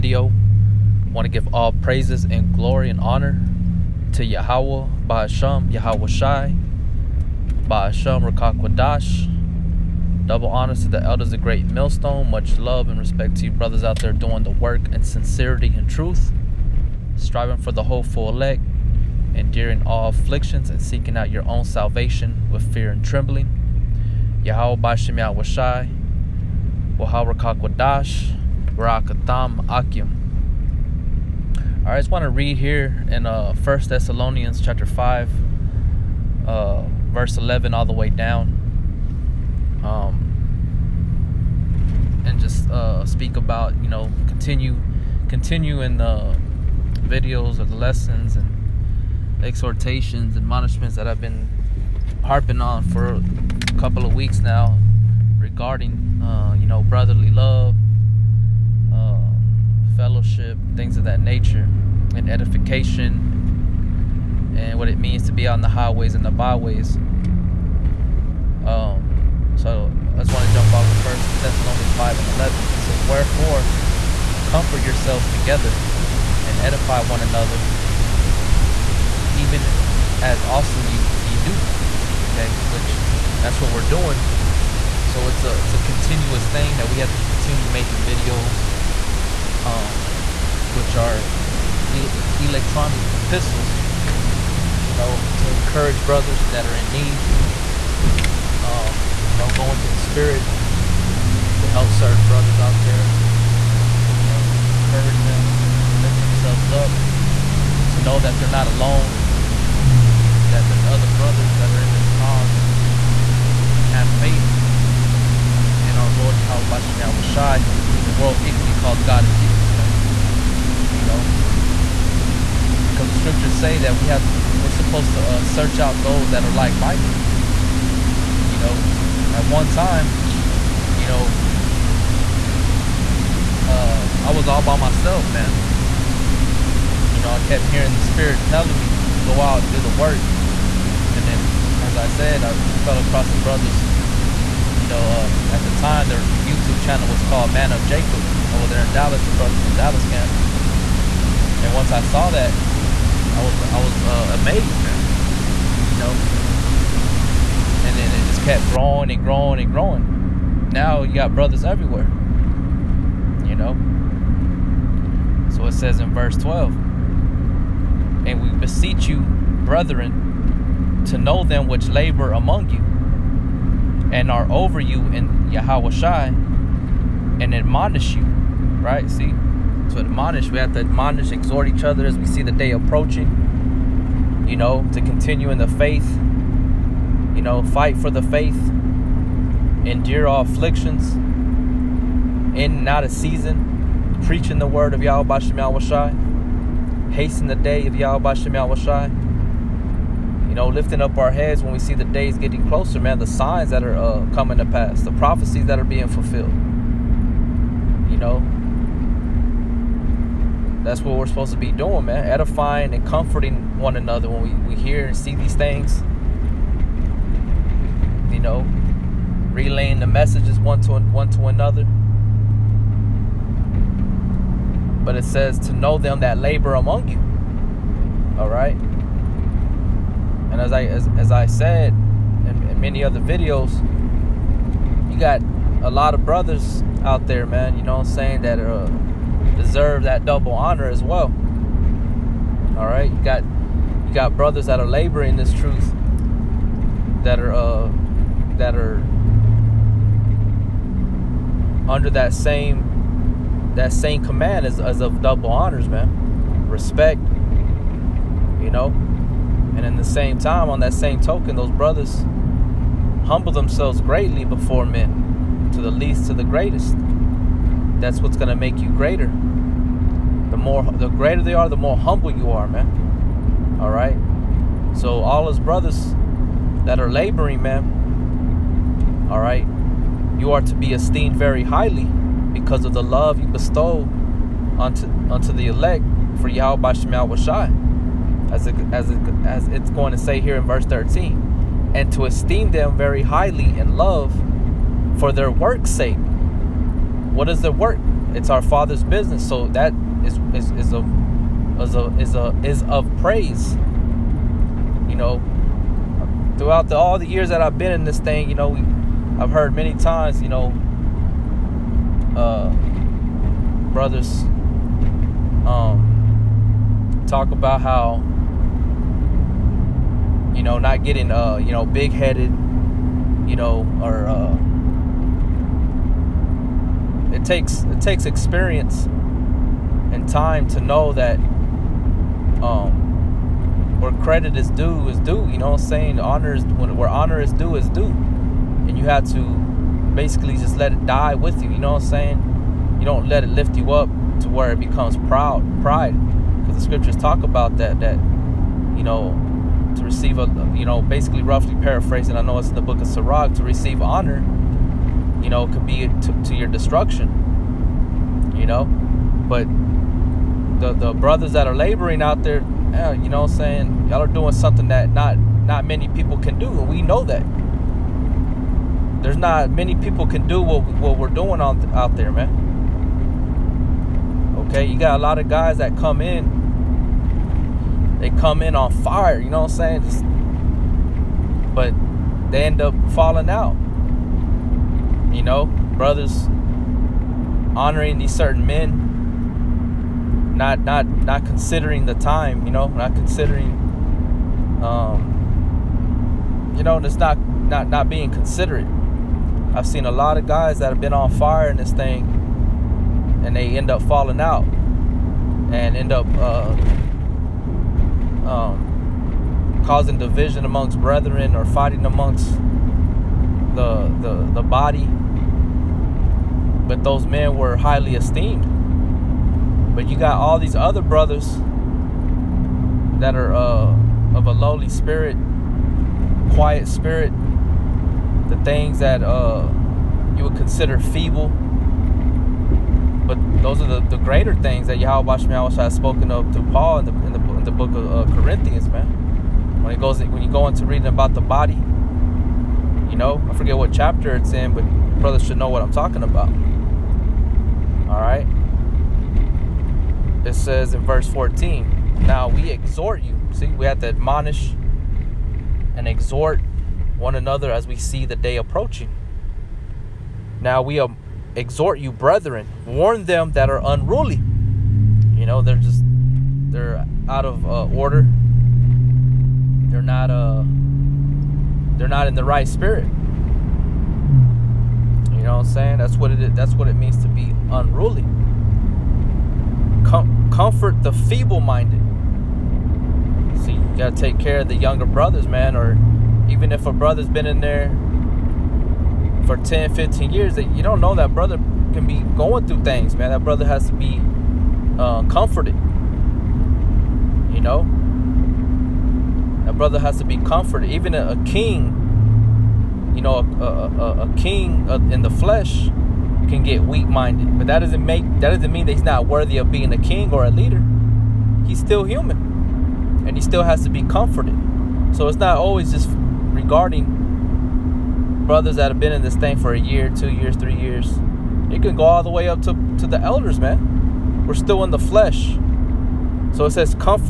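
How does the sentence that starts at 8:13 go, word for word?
That brother has to be uh, comforted know?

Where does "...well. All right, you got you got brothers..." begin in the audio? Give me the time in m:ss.
4:01.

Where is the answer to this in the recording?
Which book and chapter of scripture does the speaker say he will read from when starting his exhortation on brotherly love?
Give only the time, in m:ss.
0:33.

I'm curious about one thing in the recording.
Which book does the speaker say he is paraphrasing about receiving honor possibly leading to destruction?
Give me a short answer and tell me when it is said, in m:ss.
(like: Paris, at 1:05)
Sirach, at 5:53.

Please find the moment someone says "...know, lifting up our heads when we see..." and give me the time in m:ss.
3:20.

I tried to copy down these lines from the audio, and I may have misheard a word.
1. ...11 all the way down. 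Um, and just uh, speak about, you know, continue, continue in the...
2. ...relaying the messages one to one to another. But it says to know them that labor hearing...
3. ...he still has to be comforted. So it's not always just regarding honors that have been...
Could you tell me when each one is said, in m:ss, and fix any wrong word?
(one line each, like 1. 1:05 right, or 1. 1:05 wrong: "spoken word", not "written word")
1. 0:37 right
2. 3:39 wrong: "among", not "hearing"
3. 8:33 wrong: "brothers", not "honors".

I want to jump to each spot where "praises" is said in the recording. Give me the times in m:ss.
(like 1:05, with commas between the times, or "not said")
0:01, 5:03.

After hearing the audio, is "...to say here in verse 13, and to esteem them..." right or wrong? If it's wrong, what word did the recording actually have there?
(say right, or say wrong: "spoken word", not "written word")
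right.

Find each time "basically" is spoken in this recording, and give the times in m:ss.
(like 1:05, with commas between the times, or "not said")
5:40, 5:51.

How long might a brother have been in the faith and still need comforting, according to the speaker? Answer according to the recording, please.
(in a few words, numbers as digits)
10, 15 years.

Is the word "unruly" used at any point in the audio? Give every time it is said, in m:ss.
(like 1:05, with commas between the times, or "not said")
7:43, 7:57.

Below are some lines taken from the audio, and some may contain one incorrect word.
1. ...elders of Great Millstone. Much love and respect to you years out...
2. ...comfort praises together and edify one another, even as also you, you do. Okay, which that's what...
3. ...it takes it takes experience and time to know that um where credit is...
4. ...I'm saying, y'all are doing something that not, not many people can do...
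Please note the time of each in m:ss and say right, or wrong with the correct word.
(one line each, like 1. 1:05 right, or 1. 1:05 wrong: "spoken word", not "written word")
1. 0:11 wrong: "brothers", not "years"
2. 1:14 wrong: "yourselves", not "praises"
3. 5:27 right
4. 6:03 right.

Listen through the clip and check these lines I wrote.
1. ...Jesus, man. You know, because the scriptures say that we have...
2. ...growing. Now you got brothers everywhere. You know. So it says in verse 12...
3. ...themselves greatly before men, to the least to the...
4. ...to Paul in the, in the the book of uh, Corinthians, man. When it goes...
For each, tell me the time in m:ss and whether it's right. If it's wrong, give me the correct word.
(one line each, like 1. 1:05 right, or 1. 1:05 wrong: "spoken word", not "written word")
1. 1:59 right
2. 2:39 right
3. 4:23 right
4. 7:16 right.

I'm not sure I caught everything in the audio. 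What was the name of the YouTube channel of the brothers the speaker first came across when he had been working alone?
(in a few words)
Man Up Jacob.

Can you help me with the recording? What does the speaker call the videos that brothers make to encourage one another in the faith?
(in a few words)
electronic epistles.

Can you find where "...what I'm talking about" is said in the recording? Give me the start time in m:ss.
7:25.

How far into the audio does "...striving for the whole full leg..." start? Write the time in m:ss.
0:17.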